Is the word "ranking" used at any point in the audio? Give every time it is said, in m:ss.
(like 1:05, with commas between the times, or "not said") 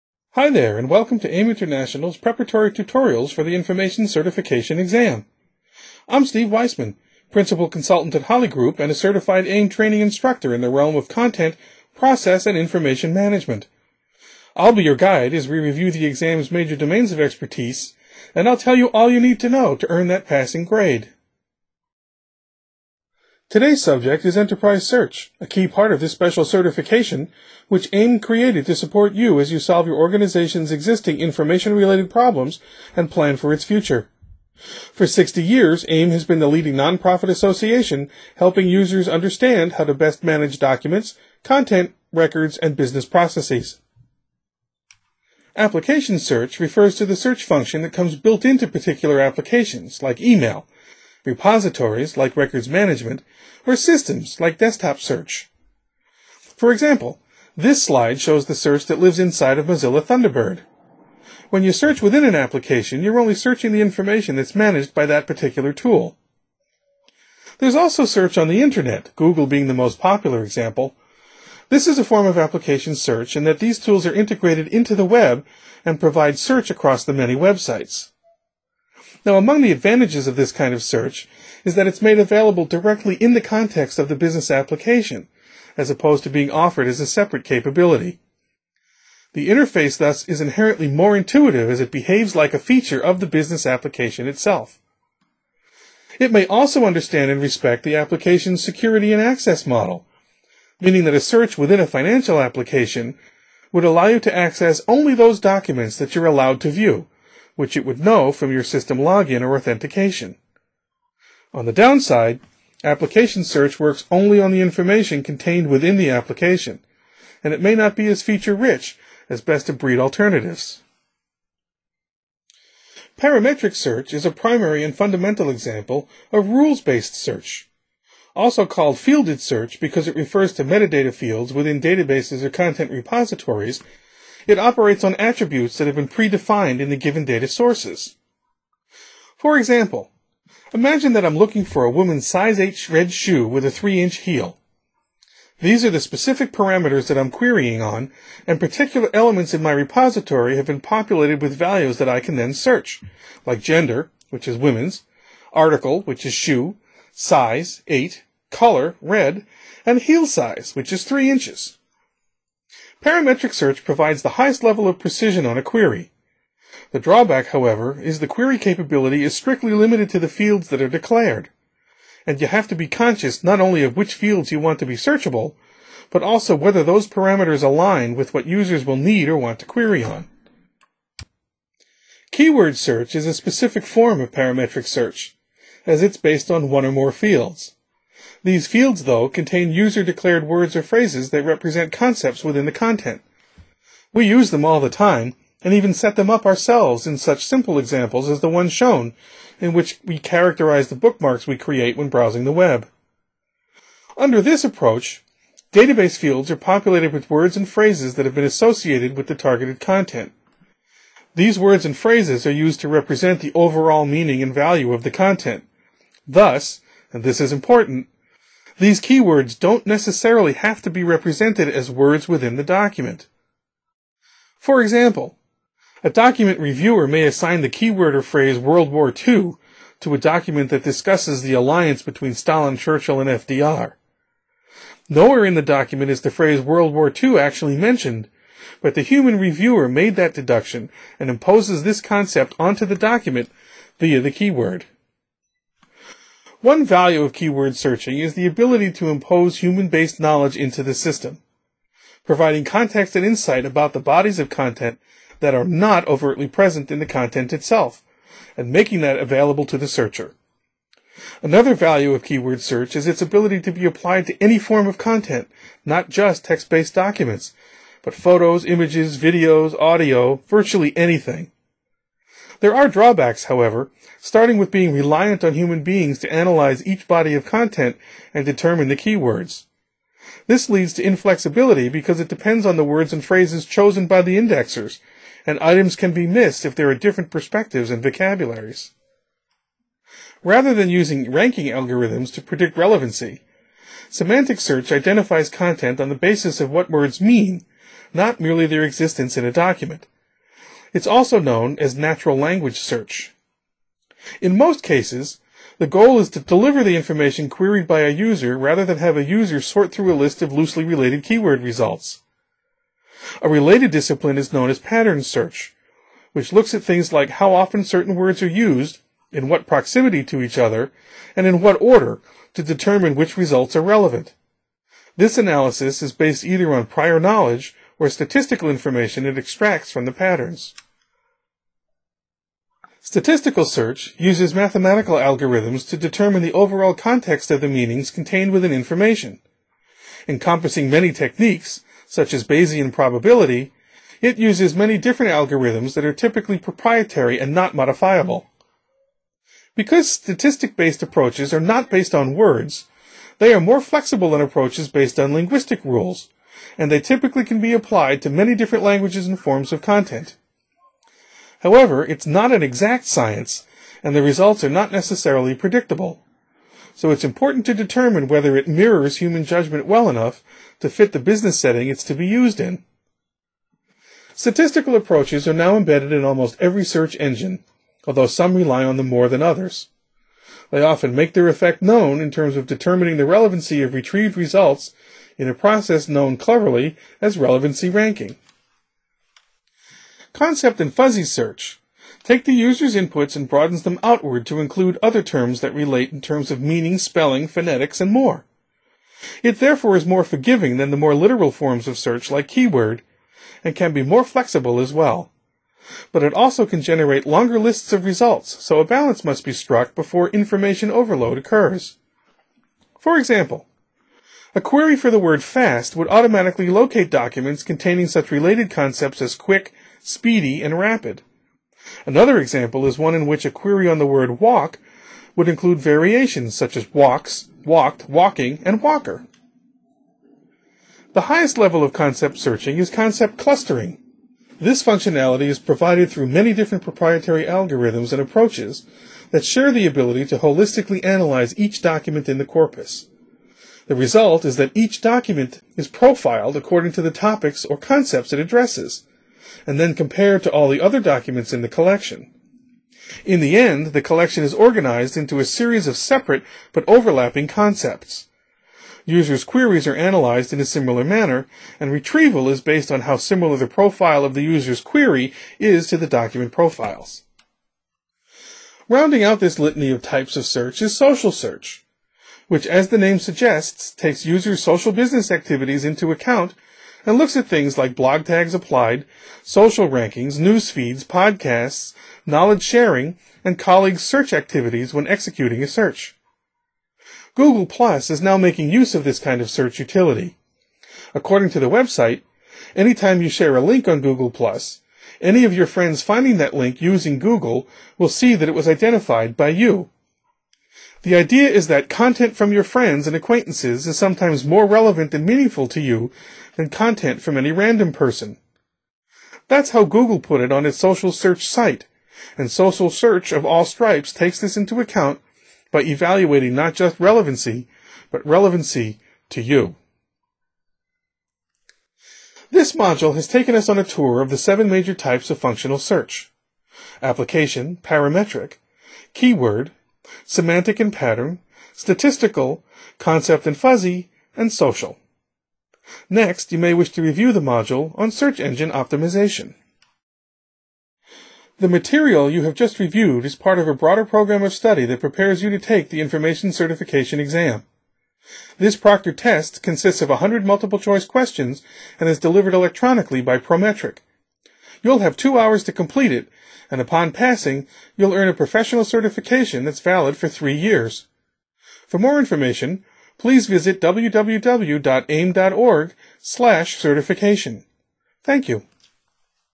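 4:51, 6:27, 7:59.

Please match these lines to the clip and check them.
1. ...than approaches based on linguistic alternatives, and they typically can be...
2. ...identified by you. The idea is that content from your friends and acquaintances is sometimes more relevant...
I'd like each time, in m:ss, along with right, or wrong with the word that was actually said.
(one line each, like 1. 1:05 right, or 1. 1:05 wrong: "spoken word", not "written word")
1. 5:54 wrong: "rules", not "alternatives"
2. 8:18 right.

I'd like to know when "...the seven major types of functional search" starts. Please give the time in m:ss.
8:44.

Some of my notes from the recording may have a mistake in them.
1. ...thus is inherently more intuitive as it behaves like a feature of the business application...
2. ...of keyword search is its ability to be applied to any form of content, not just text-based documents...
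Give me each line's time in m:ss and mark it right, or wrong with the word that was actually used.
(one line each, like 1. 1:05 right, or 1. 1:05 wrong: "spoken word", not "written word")
1. 1:29 right
2. 4:22 right.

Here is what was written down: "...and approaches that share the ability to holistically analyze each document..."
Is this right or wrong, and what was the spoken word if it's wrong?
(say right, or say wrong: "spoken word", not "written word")
right.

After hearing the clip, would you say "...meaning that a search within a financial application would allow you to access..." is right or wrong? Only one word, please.
right.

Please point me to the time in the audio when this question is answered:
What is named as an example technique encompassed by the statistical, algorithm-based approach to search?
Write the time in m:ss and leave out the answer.
5:42.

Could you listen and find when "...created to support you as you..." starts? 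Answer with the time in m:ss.
0:28.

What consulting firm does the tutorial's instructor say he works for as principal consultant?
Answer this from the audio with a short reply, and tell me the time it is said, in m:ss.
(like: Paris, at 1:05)
Holly Group, at 0:08.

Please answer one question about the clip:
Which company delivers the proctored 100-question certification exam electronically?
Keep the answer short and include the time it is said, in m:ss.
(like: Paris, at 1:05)
Prometric, at 9:13.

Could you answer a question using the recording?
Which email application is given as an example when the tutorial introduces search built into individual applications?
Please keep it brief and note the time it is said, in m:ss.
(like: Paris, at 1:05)
Mozilla Thunderbird, at 0:59.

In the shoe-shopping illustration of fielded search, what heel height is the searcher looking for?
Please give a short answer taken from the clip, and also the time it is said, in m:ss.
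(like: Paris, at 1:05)
3 inches, at 2:23.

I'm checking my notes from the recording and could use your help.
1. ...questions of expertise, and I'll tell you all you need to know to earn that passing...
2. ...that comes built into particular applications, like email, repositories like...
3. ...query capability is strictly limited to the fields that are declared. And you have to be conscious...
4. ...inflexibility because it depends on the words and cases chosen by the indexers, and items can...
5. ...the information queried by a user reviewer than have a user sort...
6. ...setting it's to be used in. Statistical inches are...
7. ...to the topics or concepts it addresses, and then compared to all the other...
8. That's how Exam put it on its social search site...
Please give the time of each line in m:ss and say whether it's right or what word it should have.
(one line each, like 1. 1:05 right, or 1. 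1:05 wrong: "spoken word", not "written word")
1. 0:16 wrong: "domains", not "questions"
2. 0:47 right
3. 2:48 right
4. 4:41 wrong: "phrases", not "cases"
5. 5:06 wrong: "rather", not "reviewer"
6. 6:11 wrong: "approaches", not "inches"
7. 7:26 right
8. 8:29 wrong: "Google", not "Exam".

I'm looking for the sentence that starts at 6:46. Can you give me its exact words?
But it also can generate longer lists of results, so a balance must be struck before information overload occurs.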